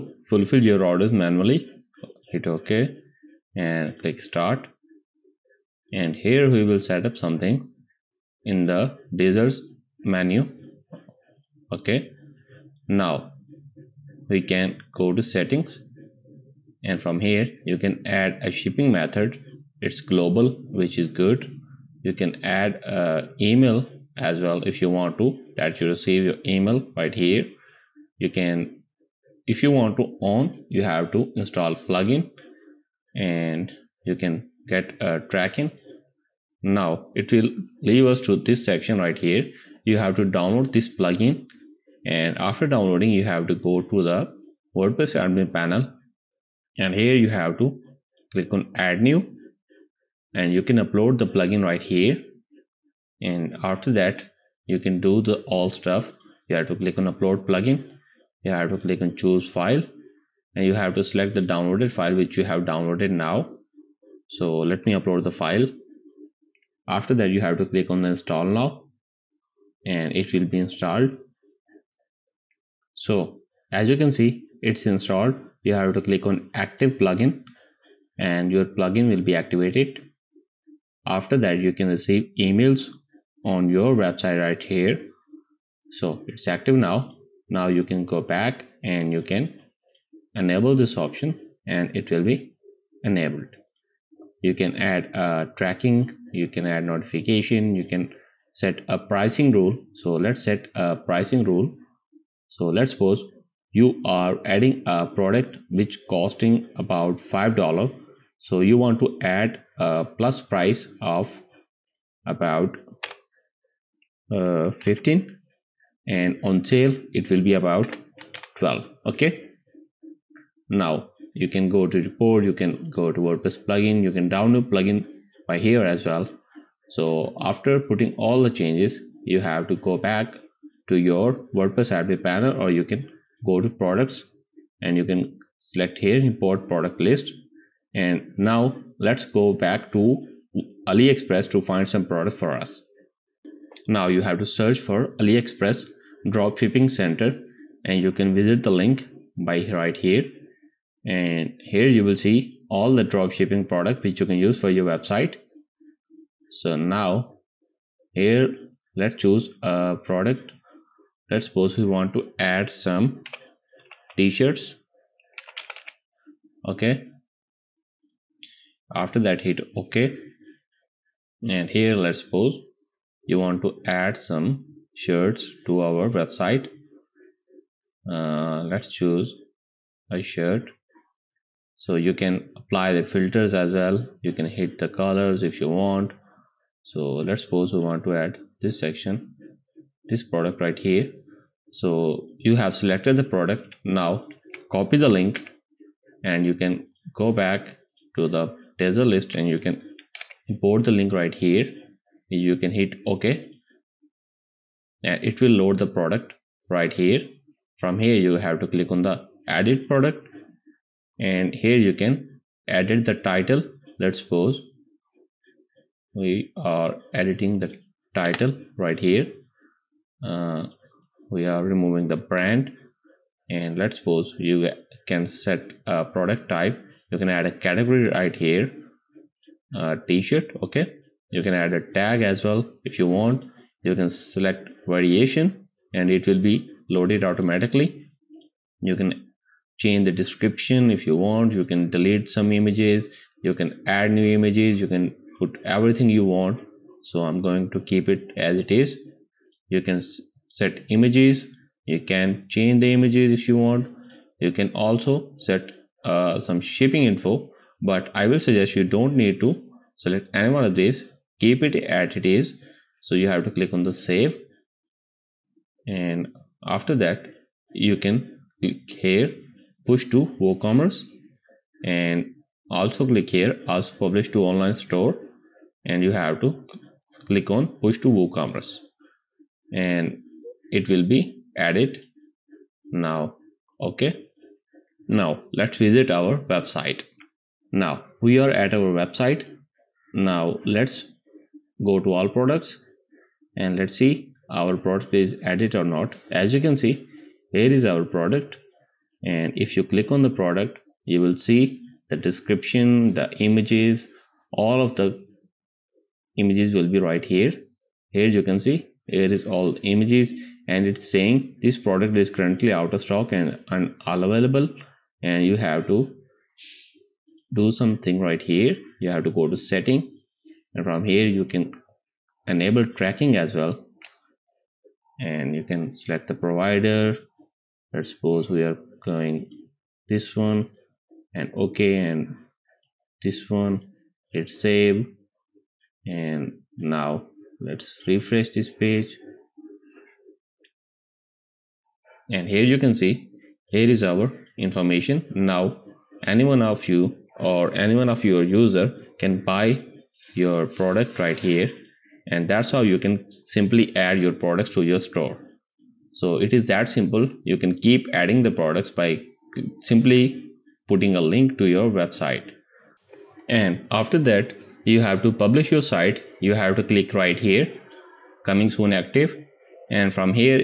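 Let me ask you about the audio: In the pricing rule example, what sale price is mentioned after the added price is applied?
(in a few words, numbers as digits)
12.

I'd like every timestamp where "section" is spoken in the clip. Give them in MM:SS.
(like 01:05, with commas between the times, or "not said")
00:38, 03:08.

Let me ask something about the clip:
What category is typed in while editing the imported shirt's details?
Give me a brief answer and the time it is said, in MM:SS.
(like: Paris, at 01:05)
t-shirt, at 03:50.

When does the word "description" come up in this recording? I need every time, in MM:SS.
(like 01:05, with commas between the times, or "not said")
04:00, 05:02.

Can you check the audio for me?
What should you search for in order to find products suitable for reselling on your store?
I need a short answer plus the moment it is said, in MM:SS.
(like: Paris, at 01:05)
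AliExpress dropshipping center, at 02:25.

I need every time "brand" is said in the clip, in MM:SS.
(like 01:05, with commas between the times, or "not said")
03:42.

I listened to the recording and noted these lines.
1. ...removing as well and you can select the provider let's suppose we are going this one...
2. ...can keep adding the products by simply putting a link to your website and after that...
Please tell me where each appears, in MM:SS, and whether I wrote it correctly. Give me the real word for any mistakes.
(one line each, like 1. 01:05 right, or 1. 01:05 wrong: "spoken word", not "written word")
1. 05:23 wrong: "tracking", not "removing"
2. 05:57 right.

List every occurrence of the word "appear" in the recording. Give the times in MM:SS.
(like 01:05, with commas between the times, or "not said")
not said.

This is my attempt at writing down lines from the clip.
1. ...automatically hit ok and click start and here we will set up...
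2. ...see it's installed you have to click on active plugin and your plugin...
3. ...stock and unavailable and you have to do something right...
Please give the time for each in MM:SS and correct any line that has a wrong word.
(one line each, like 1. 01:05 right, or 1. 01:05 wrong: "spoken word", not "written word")
1. 00:01 wrong: "manually", not "automatically"
2. 01:14 right
3. 05:13 right.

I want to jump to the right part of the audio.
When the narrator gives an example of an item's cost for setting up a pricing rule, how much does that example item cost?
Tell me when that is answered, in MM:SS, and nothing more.
01:47.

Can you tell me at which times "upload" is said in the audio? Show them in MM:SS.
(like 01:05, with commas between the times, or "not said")
00:50, 00:57, 01:04.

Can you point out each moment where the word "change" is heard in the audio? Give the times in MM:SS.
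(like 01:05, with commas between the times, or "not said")
02:08, 03:59, 04:12.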